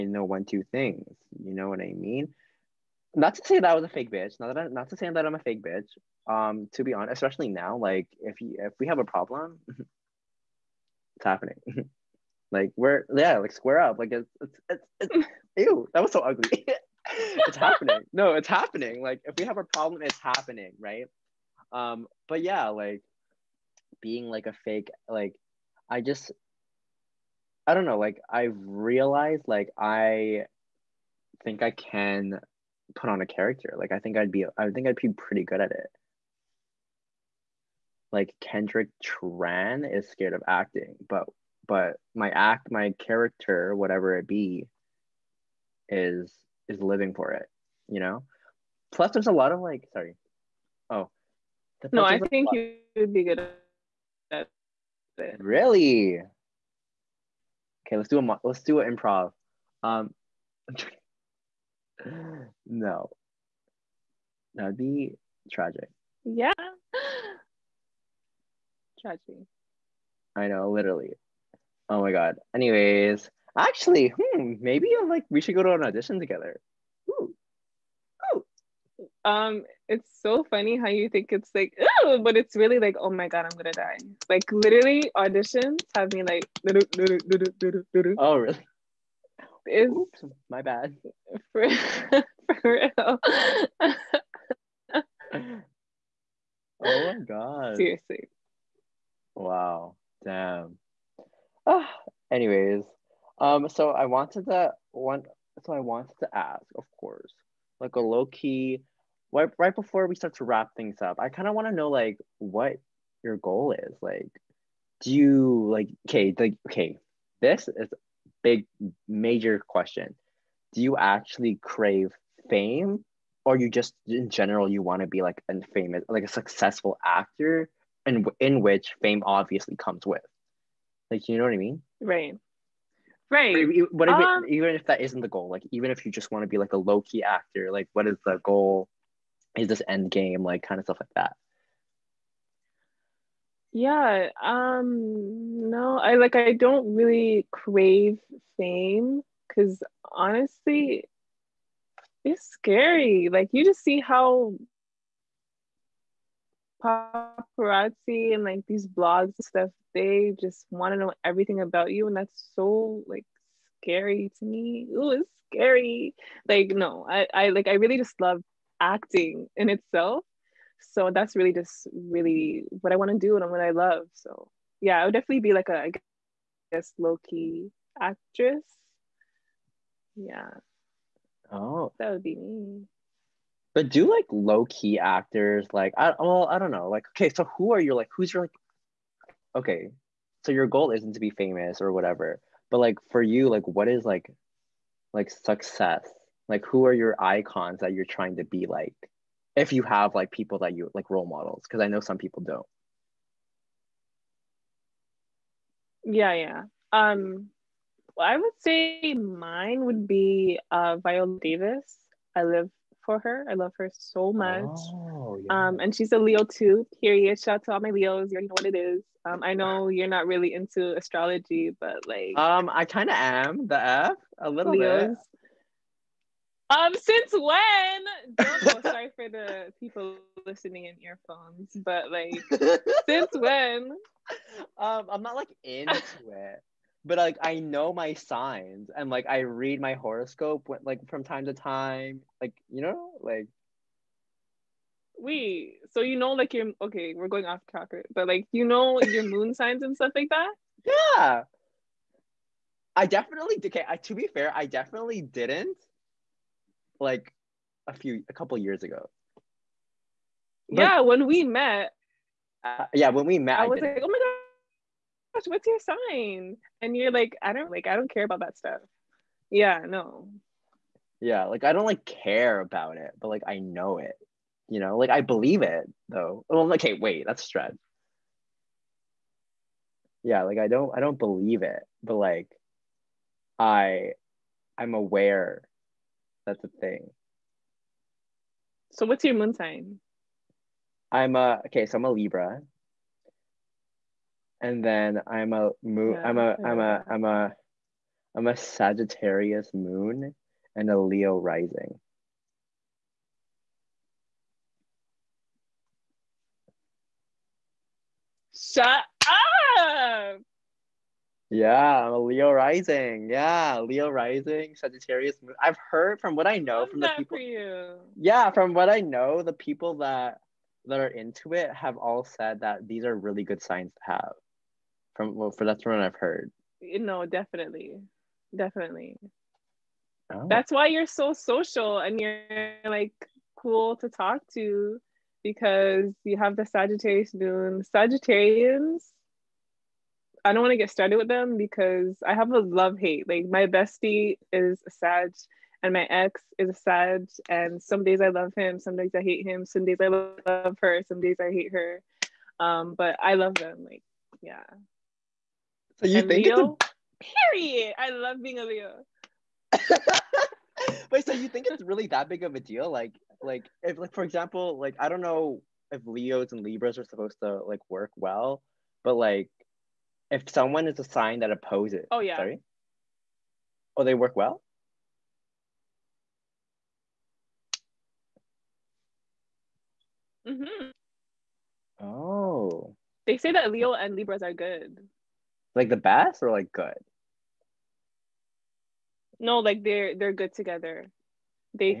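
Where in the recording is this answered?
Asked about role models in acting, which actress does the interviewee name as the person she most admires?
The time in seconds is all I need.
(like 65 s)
210 s.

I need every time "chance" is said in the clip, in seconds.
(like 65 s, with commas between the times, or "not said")
not said.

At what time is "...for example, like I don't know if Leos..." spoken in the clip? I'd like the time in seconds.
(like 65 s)
364 s.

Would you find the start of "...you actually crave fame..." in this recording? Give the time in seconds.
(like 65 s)
120 s.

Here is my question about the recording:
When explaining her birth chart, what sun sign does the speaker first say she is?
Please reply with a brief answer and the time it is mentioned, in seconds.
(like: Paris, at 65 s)
Libra, at 291 s.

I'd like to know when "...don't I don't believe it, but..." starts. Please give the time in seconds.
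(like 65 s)
280 s.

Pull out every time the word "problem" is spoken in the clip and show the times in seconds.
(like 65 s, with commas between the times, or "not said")
9 s, 19 s.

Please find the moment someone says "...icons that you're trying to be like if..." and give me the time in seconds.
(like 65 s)
197 s.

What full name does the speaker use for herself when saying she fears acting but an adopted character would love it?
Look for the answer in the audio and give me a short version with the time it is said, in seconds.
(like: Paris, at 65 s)
Kendrick Tran, at 38 s.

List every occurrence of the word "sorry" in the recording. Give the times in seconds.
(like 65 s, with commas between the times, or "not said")
49 s, 228 s, 372 s.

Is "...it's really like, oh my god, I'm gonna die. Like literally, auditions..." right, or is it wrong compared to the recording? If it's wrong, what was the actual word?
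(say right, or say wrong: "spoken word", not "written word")
right.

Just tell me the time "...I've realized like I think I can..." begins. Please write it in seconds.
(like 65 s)
28 s.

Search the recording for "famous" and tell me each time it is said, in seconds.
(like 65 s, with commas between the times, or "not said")
125 s, 191 s.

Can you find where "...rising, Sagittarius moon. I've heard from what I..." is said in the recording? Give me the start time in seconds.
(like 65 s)
314 s.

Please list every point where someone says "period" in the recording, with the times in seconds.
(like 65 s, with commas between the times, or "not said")
217 s, 357 s.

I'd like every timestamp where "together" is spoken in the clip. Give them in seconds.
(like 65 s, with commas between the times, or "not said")
76 s, 390 s.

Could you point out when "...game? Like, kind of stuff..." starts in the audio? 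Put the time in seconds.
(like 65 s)
140 s.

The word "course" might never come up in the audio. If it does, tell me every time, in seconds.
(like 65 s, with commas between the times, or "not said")
106 s.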